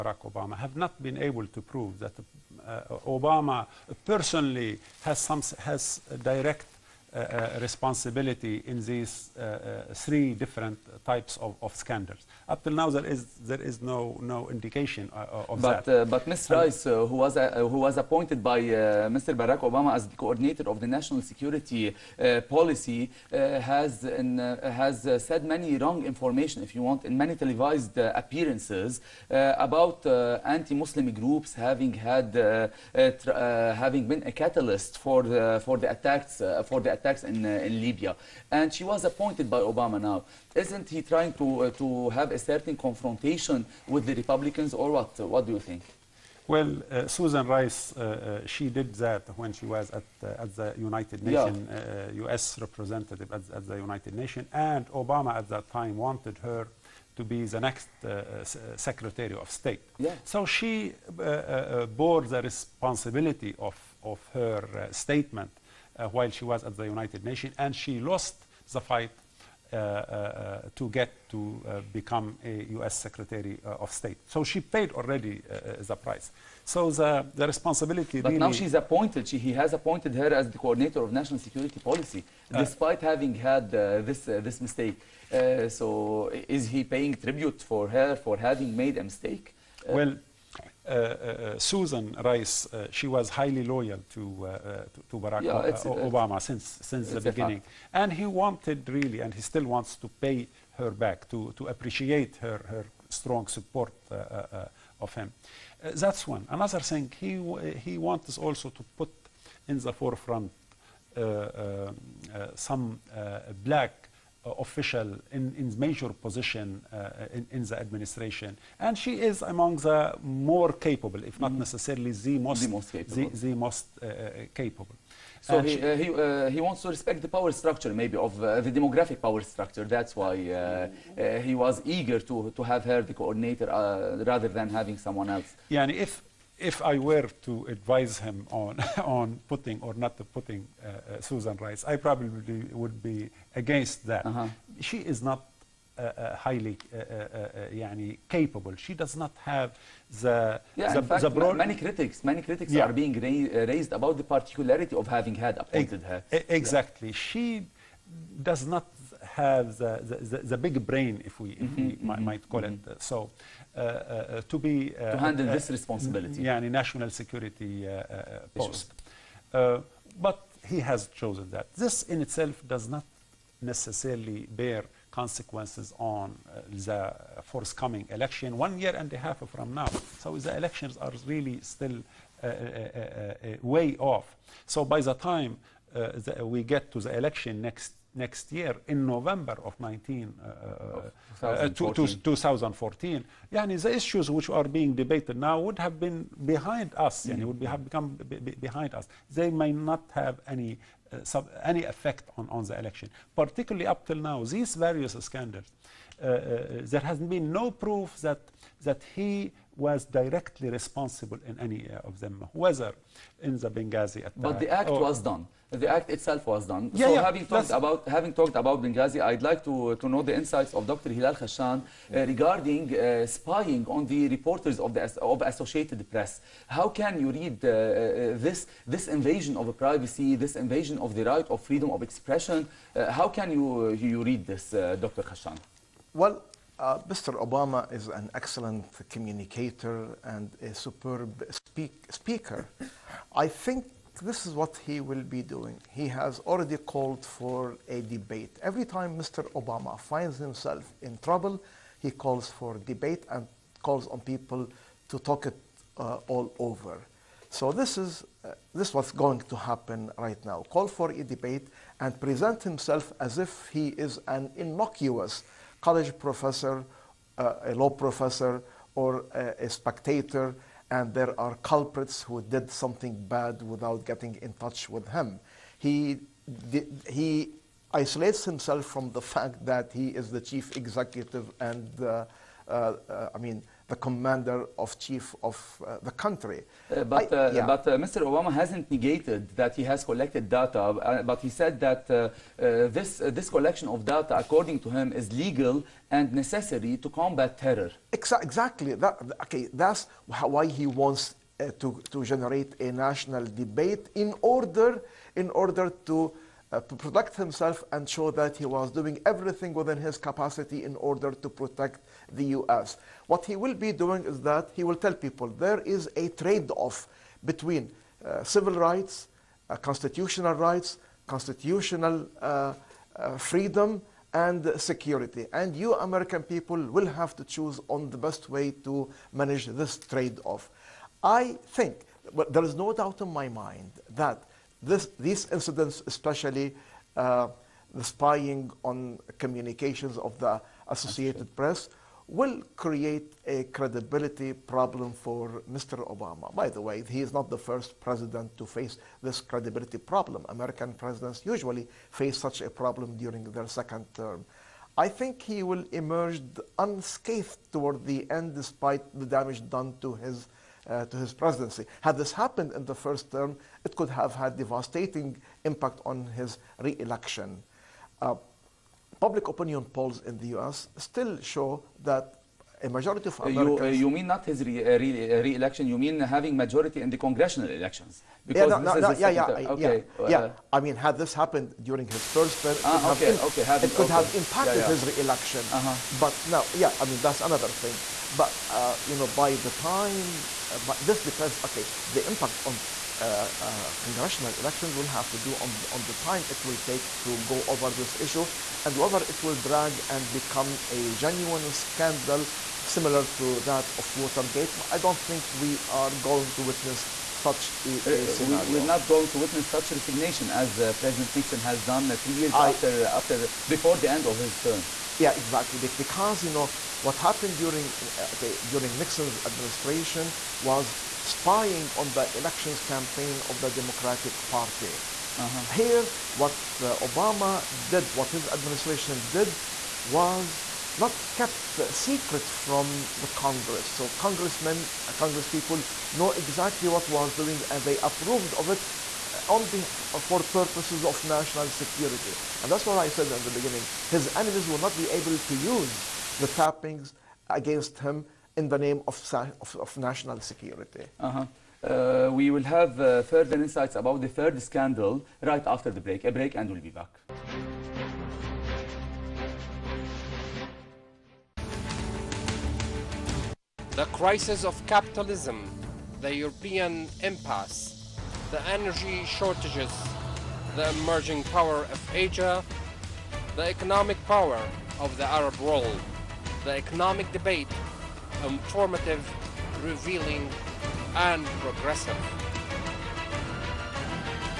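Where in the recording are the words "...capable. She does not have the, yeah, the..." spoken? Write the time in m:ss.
2:28.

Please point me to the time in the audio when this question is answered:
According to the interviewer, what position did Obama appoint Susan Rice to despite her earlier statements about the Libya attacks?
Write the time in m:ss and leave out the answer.
0:20.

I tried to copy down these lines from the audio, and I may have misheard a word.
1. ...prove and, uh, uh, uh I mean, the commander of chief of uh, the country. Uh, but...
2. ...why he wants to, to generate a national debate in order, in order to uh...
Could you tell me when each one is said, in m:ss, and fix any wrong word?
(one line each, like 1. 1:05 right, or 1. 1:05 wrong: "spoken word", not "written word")
1. 4:40 wrong: "executive", not "prove"
2. 5:00 right.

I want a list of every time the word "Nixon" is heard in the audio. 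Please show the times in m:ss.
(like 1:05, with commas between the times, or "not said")
6:51, 6:58.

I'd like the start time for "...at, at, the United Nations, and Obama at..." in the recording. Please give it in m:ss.
0:53.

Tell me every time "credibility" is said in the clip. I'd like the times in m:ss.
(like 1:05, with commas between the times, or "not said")
5:43, 5:49.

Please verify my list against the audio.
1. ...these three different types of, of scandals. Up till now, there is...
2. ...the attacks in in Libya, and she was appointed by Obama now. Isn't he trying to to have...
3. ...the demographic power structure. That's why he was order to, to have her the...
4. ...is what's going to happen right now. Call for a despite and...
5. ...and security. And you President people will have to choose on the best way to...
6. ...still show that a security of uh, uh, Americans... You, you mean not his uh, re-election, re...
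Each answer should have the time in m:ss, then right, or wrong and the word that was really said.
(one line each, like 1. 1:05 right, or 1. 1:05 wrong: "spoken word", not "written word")
1. 0:08 right
2. 0:36 right
3. 2:08 wrong: "eager", not "order"
4. 4:18 wrong: "debate", not "despite"
5. 5:24 wrong: "American", not "President"
6. 6:10 wrong: "majority", not "security".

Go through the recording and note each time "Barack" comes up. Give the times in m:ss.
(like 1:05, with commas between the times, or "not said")
0:19, 1:35.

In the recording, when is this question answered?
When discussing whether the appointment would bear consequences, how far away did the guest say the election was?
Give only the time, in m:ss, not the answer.
2:58.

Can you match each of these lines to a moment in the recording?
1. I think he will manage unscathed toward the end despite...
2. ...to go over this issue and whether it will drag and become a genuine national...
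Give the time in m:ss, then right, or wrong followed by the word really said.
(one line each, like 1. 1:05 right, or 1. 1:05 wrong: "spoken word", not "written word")
1. 5:54 wrong: "emerge", not "manage"
2. 6:37 wrong: "scandal", not "national".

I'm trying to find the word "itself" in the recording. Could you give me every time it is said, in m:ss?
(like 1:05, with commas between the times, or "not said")
2:52, 3:36.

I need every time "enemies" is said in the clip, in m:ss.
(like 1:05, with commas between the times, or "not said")
7:24.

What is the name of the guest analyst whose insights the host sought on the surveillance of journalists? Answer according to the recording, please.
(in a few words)
Hilal Khashan.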